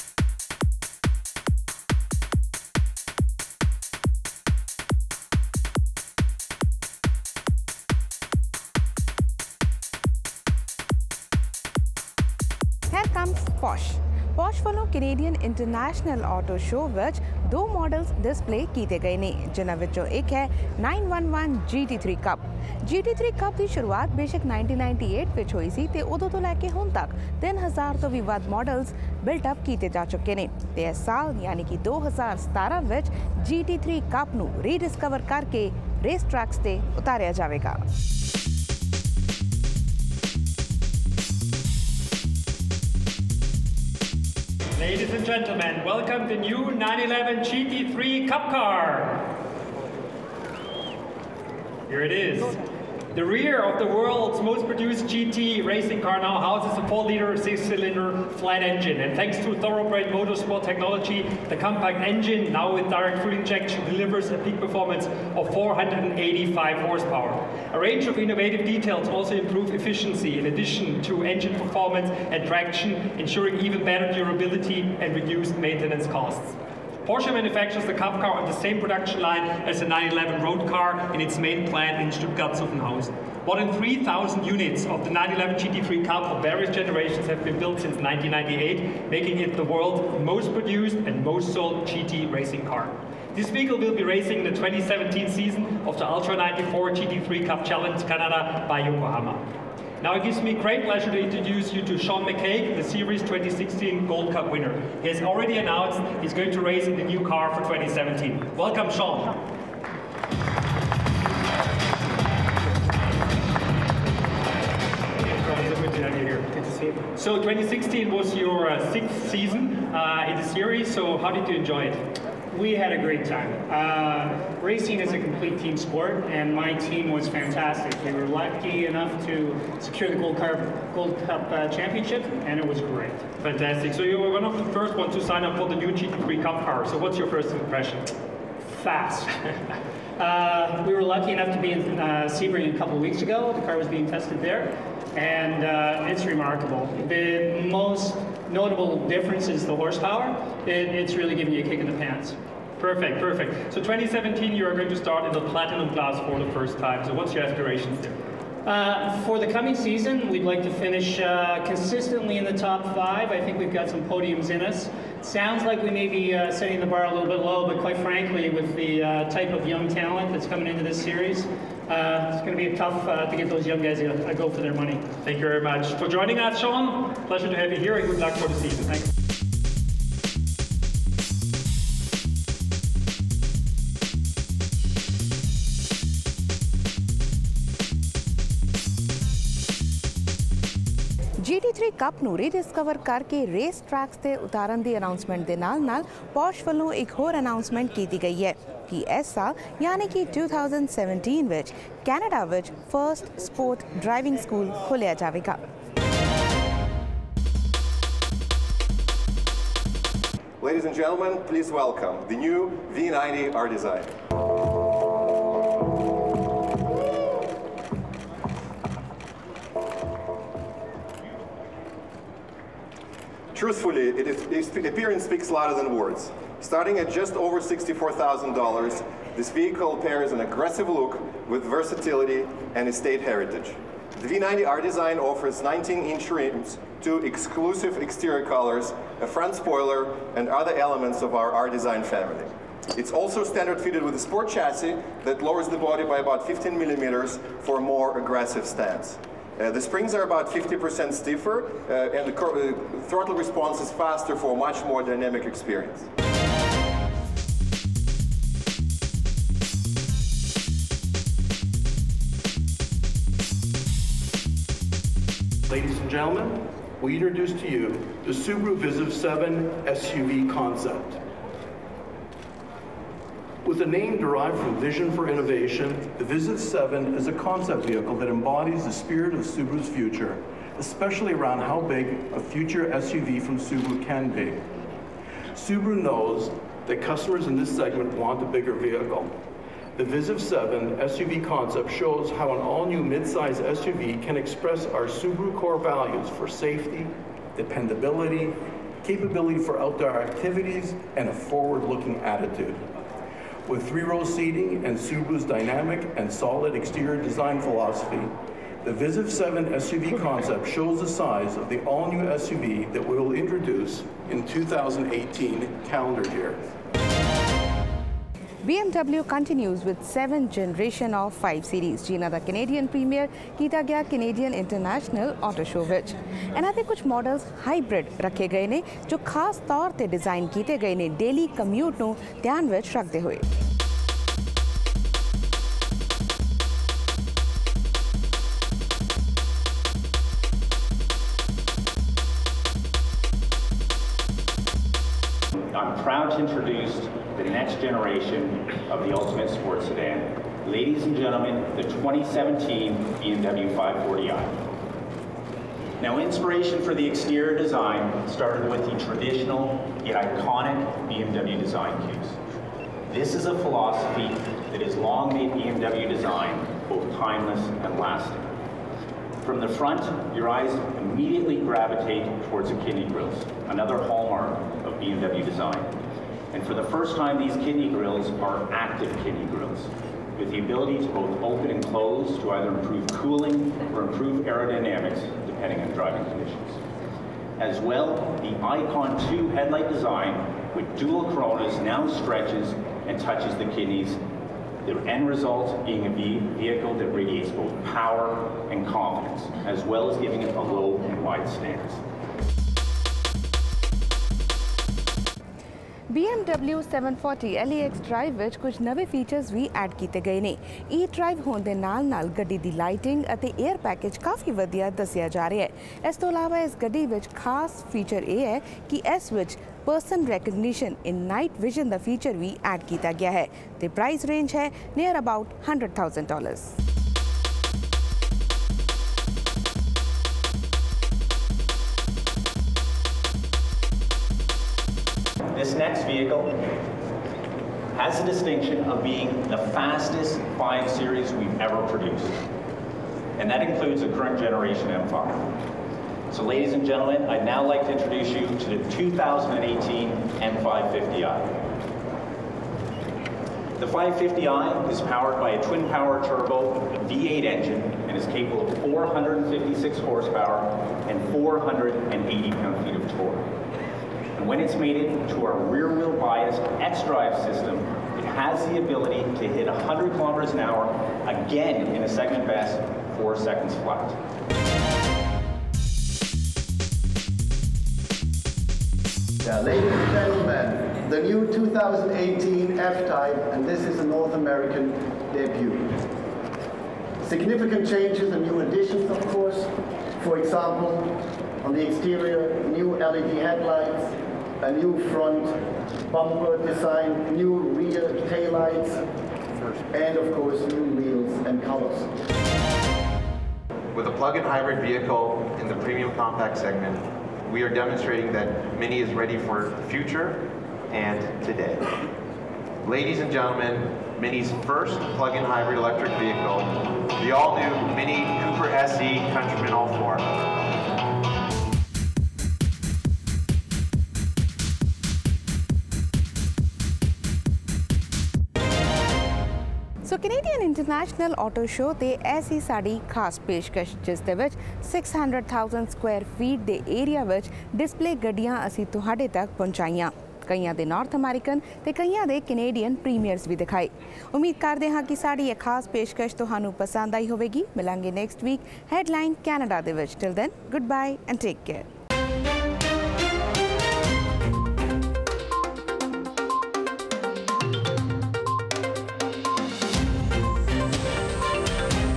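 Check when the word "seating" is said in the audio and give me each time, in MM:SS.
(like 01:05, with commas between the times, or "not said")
05:04.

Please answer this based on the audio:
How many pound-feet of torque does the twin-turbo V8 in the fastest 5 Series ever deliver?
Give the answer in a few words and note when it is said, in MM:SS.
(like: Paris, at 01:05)
480, at 07:41.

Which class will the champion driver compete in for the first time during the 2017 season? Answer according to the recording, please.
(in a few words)
Platinum.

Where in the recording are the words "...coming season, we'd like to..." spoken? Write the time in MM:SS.
02:39.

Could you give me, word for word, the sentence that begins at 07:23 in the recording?
And that includes the current generation M5.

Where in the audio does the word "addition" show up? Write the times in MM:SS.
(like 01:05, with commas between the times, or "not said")
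01:10, 08:08.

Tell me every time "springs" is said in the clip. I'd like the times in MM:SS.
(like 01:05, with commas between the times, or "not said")
04:09.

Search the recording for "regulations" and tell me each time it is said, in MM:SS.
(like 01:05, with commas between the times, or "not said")
not said.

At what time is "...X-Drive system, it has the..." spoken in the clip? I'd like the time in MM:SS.
07:46.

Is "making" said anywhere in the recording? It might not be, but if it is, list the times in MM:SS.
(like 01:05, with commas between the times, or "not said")
01:29.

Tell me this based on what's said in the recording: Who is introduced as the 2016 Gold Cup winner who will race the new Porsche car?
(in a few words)
Sean McCaig.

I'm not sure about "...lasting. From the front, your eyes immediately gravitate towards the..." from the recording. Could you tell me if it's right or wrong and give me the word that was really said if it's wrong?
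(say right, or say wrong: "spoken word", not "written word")
right.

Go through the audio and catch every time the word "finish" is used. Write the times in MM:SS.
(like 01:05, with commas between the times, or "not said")
02:40.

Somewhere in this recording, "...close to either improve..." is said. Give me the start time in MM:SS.
06:21.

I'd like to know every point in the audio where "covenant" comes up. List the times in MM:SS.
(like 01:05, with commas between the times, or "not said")
not said.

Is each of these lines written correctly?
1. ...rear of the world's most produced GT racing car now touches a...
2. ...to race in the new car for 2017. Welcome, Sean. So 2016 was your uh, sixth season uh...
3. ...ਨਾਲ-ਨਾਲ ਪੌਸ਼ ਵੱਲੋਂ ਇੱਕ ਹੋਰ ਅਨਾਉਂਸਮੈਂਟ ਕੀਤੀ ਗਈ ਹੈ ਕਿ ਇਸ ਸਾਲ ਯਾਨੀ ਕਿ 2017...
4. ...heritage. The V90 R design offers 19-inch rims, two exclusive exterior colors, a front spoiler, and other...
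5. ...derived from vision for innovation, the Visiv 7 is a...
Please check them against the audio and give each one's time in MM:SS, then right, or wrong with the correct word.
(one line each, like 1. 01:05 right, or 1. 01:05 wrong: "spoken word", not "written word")
1. 00:53 wrong: "houses", not "touches"
2. 01:46 right
3. 03:15 right
4. 03:53 right
5. 04:34 right.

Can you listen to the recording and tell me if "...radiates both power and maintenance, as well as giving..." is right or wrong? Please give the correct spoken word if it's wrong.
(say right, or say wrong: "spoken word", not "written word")
wrong: "confidence", not "maintenance".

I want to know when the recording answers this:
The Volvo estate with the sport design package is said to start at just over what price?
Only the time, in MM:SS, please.
03:47.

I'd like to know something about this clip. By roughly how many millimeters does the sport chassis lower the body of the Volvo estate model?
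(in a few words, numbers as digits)
15 millimeters.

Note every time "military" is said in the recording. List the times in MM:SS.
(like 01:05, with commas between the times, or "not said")
not said.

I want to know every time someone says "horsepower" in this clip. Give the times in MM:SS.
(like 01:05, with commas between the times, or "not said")
01:06, 02:29, 07:39.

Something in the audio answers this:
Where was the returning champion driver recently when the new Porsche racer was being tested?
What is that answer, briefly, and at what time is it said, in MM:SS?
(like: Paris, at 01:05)
Sebring, at 02:22.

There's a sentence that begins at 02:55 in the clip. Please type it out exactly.
Thank you very much for joining us, Sean.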